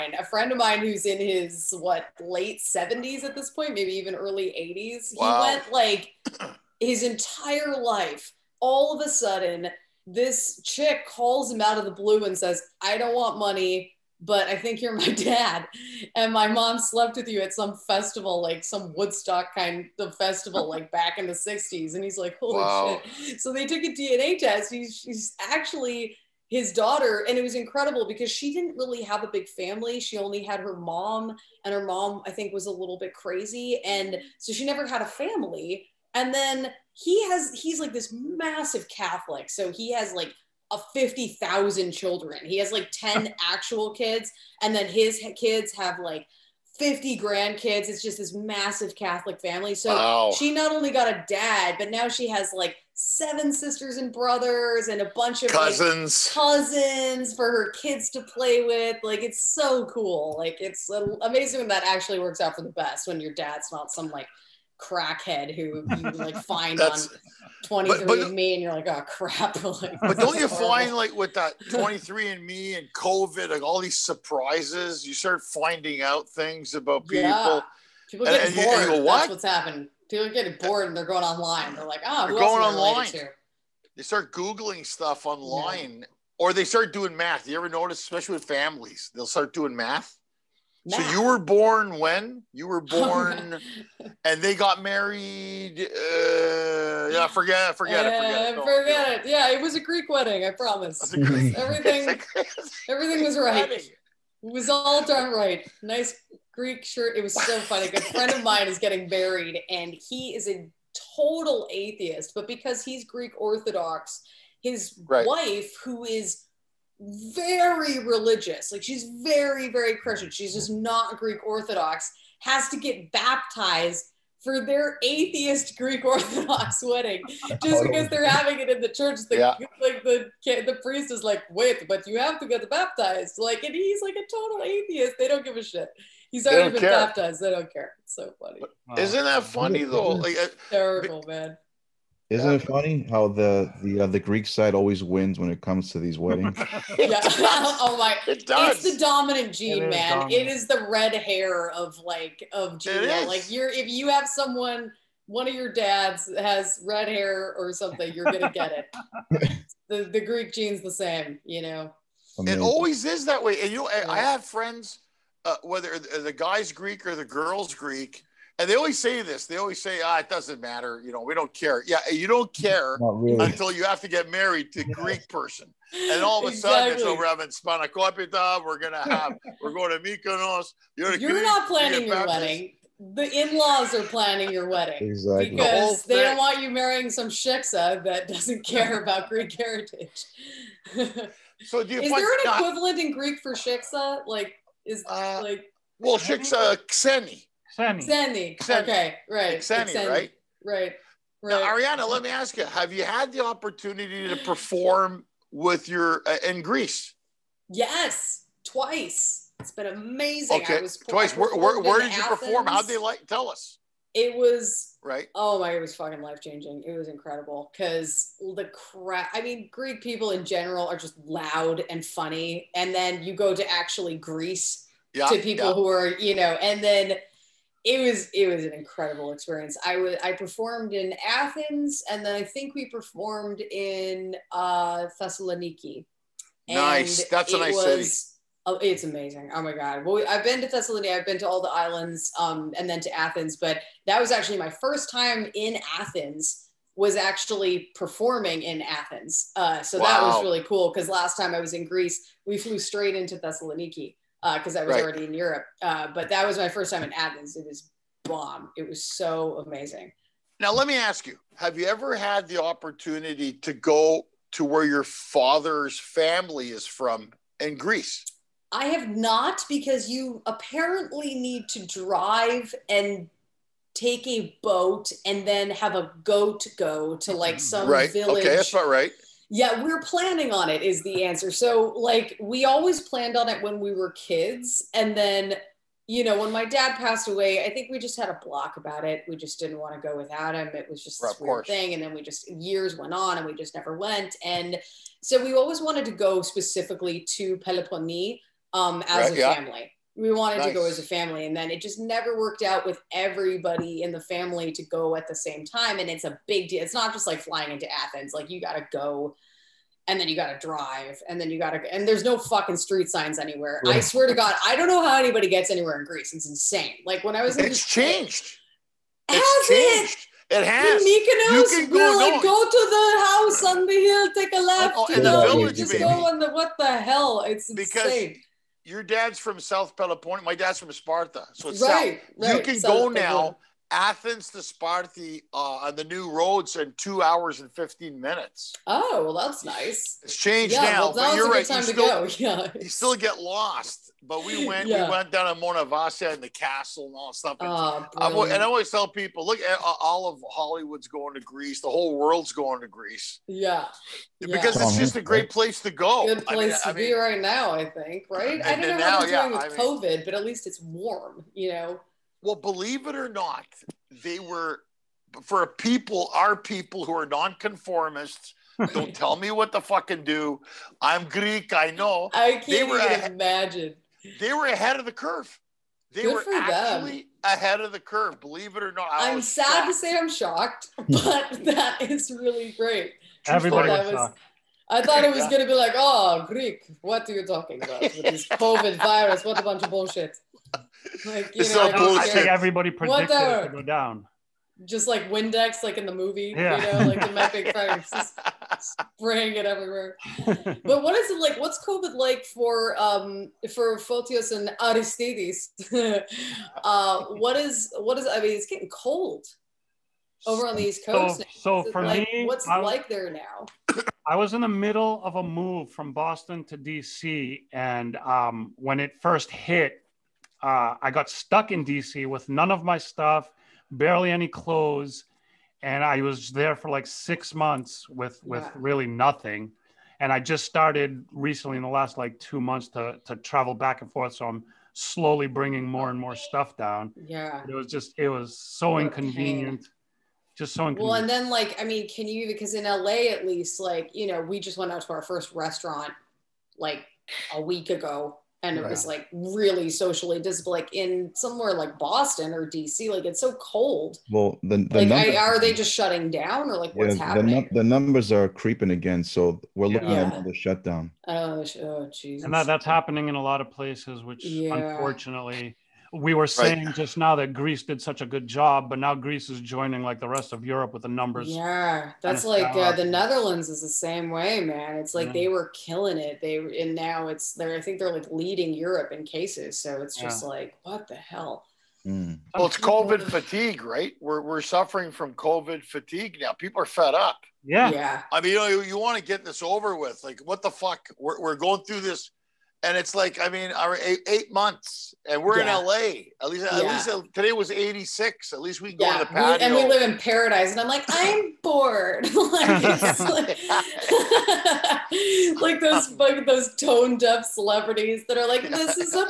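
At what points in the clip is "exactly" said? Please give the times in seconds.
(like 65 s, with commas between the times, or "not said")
176 s, 185 s.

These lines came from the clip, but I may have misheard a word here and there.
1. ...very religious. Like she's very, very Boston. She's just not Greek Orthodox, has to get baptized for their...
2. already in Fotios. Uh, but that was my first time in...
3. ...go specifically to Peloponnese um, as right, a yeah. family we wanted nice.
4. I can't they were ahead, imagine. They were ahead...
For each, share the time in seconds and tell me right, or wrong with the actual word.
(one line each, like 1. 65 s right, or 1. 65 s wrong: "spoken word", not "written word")
1. 117 s wrong: "Christian", not "Boston"
2. 255 s wrong: "Europe", not "Fotios"
3. 296 s right
4. 372 s right.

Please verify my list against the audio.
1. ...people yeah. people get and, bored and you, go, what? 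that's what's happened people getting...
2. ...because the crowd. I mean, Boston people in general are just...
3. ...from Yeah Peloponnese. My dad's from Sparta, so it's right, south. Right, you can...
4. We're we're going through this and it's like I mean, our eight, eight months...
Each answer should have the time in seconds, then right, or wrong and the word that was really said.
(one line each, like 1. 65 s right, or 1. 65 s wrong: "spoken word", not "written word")
1. 77 s right
2. 217 s wrong: "Greek", not "Boston"
3. 329 s wrong: "South", not "Yeah"
4. 491 s right.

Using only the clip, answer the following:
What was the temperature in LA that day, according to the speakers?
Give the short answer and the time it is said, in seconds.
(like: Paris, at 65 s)
86, at 497 s.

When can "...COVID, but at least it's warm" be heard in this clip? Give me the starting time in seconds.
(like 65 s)
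360 s.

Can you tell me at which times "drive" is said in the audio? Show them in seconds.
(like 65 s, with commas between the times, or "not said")
271 s, 310 s.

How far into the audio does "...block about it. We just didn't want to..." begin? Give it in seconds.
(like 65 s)
288 s.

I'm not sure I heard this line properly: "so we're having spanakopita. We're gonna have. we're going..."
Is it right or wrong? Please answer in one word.
right.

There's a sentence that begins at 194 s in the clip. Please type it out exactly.
Like, is uh, like well, shiksa xeni.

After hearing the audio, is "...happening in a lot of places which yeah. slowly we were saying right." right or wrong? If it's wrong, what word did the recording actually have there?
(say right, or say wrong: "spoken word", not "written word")
wrong: "unfortunately", not "slowly".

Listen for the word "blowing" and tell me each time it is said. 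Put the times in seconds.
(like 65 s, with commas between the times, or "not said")
not said.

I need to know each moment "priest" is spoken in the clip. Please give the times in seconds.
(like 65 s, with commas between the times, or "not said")
130 s.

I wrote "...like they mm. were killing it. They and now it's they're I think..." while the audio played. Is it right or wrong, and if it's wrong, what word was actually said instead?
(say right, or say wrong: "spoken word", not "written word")
right.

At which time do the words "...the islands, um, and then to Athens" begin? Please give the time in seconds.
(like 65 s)
241 s.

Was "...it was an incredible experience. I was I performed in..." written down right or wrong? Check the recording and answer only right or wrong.
right.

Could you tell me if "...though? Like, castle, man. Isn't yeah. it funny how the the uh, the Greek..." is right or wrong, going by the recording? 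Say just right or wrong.
wrong.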